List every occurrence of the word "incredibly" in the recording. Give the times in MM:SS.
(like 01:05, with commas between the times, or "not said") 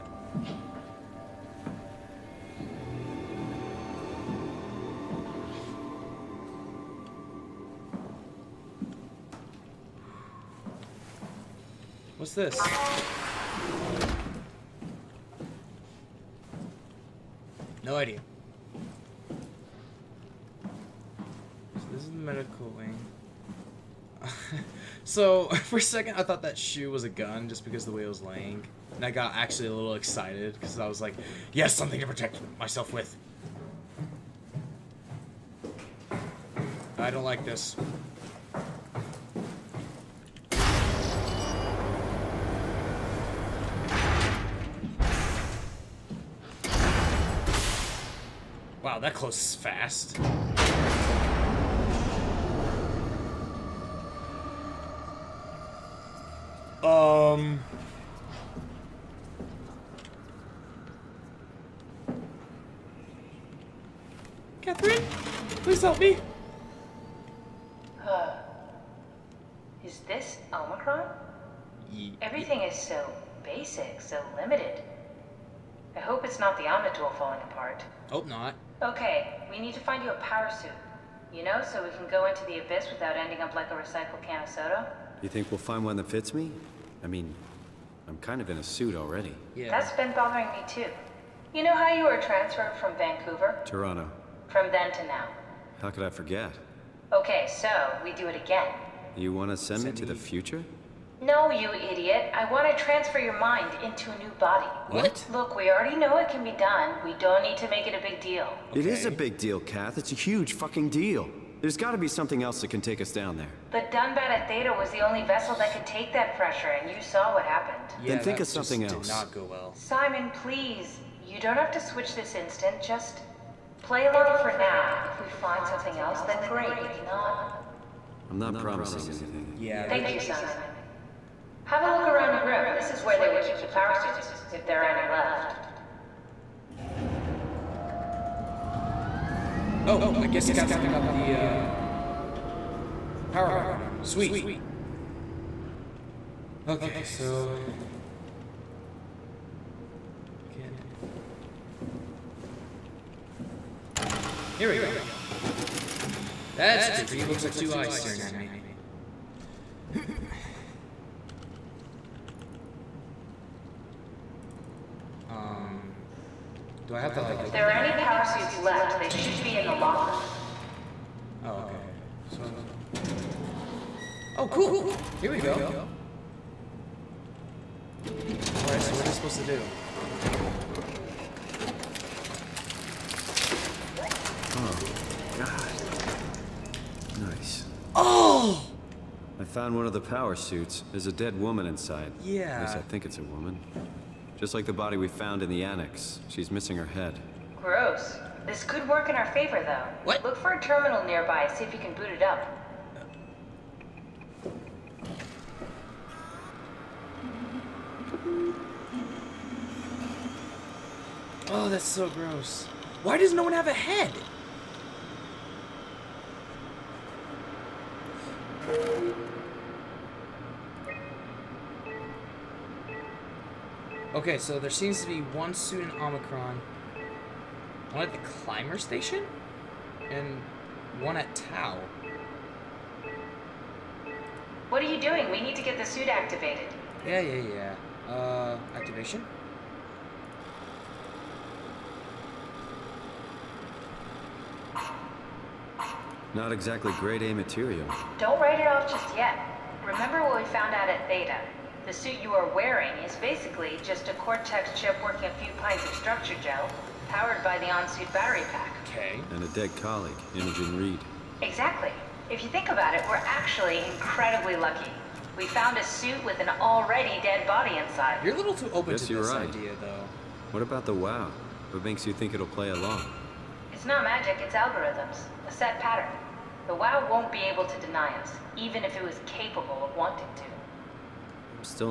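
04:23.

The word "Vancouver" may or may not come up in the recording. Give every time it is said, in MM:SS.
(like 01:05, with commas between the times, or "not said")
01:32.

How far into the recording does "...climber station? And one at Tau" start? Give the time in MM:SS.
03:48.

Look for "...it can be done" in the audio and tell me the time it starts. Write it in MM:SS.
01:46.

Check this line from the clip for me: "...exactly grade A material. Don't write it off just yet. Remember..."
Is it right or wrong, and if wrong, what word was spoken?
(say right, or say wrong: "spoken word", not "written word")
right.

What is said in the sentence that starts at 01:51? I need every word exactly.
There's got to be something else that can take us down there.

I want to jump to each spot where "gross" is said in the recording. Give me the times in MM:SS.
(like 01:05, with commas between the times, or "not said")
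03:17, 03:32.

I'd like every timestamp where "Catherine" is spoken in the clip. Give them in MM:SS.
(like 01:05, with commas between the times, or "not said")
01:04, 02:20.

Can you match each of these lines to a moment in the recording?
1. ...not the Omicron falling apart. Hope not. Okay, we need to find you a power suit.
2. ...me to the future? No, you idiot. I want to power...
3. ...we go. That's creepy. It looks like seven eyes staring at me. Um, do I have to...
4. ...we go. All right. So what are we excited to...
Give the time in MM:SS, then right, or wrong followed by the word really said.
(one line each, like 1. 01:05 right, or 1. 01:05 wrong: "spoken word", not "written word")
1. 01:16 wrong: "Omnitool", not "Omicron"
2. 01:39 wrong: "transfer", not "power"
3. 02:34 wrong: "two", not "seven"
4. 02:55 wrong: "supposed", not "excited".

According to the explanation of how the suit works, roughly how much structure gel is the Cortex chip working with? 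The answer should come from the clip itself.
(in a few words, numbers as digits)
a few pints.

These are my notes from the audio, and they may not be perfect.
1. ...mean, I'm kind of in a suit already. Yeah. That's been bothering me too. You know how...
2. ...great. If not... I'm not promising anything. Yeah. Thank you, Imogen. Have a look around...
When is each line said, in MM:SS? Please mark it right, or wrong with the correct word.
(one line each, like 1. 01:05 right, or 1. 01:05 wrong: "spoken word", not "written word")
1. 01:27 right
2. 02:06 wrong: "Simon", not "Imogen".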